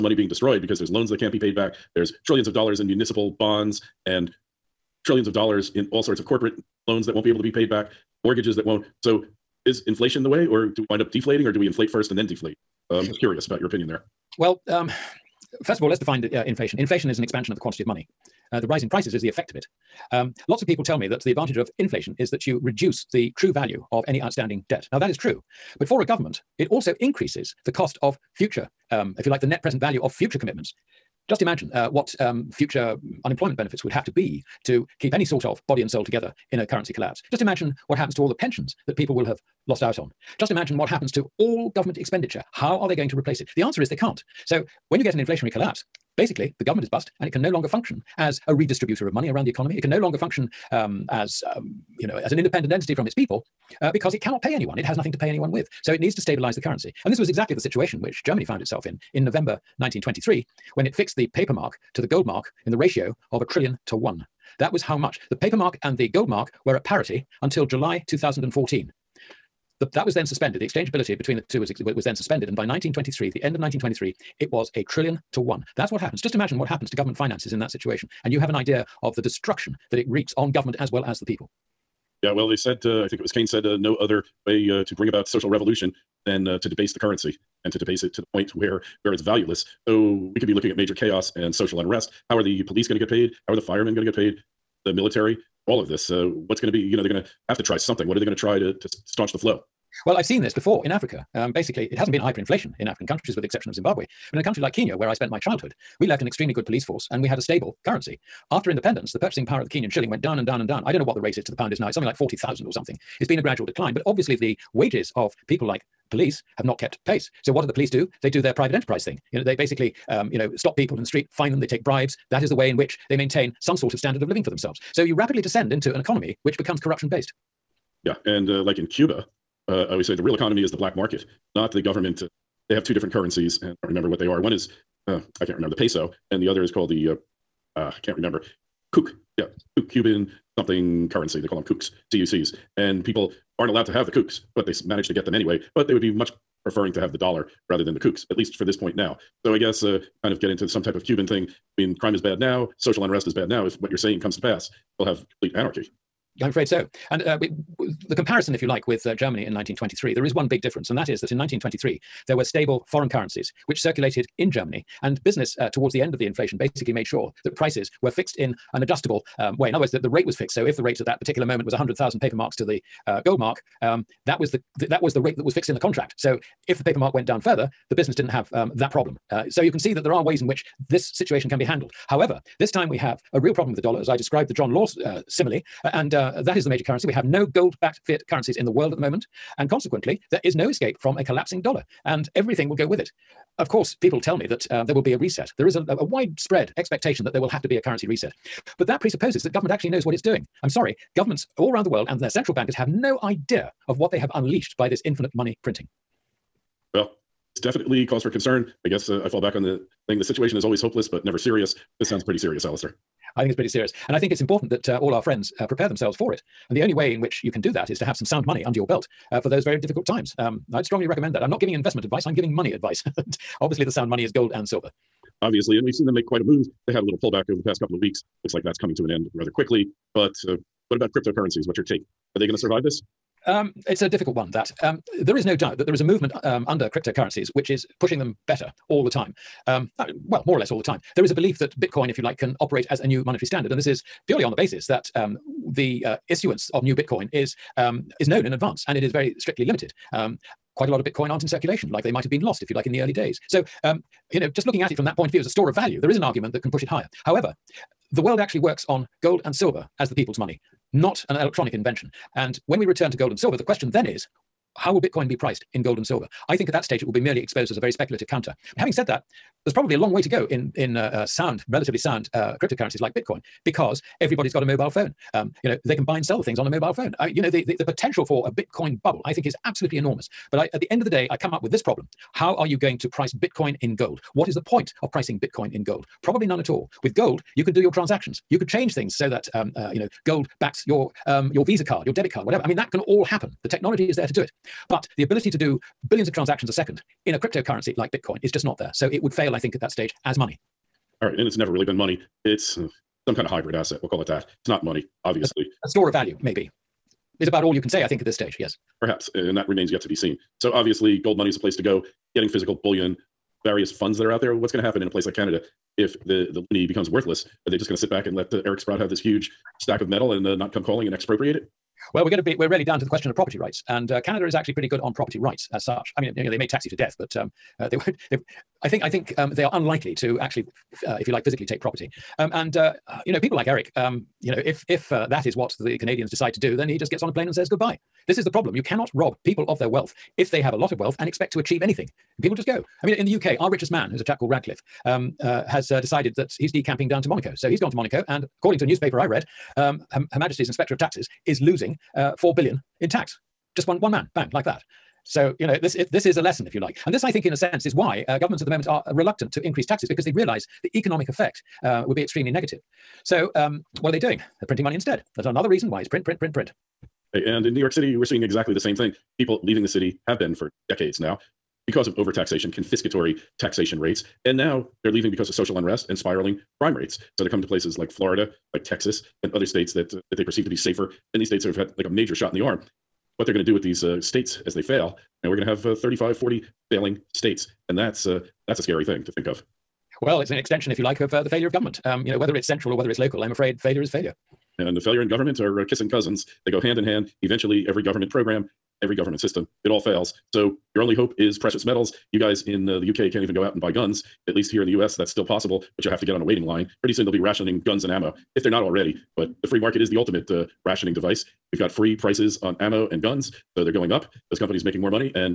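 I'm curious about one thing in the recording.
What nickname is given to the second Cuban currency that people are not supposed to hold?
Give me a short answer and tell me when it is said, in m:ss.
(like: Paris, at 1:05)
kooks (CUCs), at 2:21.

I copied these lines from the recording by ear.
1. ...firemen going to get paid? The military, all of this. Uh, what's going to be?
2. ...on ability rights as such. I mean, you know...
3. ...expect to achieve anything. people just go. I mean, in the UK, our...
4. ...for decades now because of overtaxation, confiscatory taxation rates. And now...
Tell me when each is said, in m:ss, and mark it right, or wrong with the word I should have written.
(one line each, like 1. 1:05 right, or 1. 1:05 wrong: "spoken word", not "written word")
1. 1:33 right
2. 5:24 wrong: "property", not "ability"
3. 5:41 right
4. 6:10 right.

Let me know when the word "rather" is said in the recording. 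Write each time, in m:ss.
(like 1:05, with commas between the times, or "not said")
2:27, 3:49.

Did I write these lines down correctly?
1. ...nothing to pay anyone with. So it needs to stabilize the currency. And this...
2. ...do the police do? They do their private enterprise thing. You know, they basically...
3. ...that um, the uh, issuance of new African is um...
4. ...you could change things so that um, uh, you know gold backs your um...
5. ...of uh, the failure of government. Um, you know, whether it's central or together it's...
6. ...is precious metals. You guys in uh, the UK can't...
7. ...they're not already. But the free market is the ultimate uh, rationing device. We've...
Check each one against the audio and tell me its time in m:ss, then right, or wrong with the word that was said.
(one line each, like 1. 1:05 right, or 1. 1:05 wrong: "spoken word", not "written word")
1. 0:54 right
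2. 1:57 right
3. 4:04 wrong: "Bitcoin", not "African"
4. 4:48 right
5. 6:31 wrong: "whether", not "together"
6. 6:41 right
7. 6:48 right.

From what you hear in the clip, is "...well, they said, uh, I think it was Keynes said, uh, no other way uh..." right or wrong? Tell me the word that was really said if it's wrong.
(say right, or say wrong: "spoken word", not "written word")
right.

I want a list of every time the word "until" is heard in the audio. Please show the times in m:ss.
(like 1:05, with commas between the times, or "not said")
1:07.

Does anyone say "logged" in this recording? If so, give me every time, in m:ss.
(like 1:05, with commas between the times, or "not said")
not said.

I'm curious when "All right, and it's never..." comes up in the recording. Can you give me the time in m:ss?
5:01.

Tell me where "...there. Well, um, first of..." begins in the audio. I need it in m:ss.
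0:13.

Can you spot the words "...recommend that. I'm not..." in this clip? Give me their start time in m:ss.
3:41.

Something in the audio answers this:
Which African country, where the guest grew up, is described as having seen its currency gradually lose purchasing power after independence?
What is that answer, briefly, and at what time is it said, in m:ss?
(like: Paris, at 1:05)
Kenya, at 1:44.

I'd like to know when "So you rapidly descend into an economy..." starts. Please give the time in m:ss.
2:04.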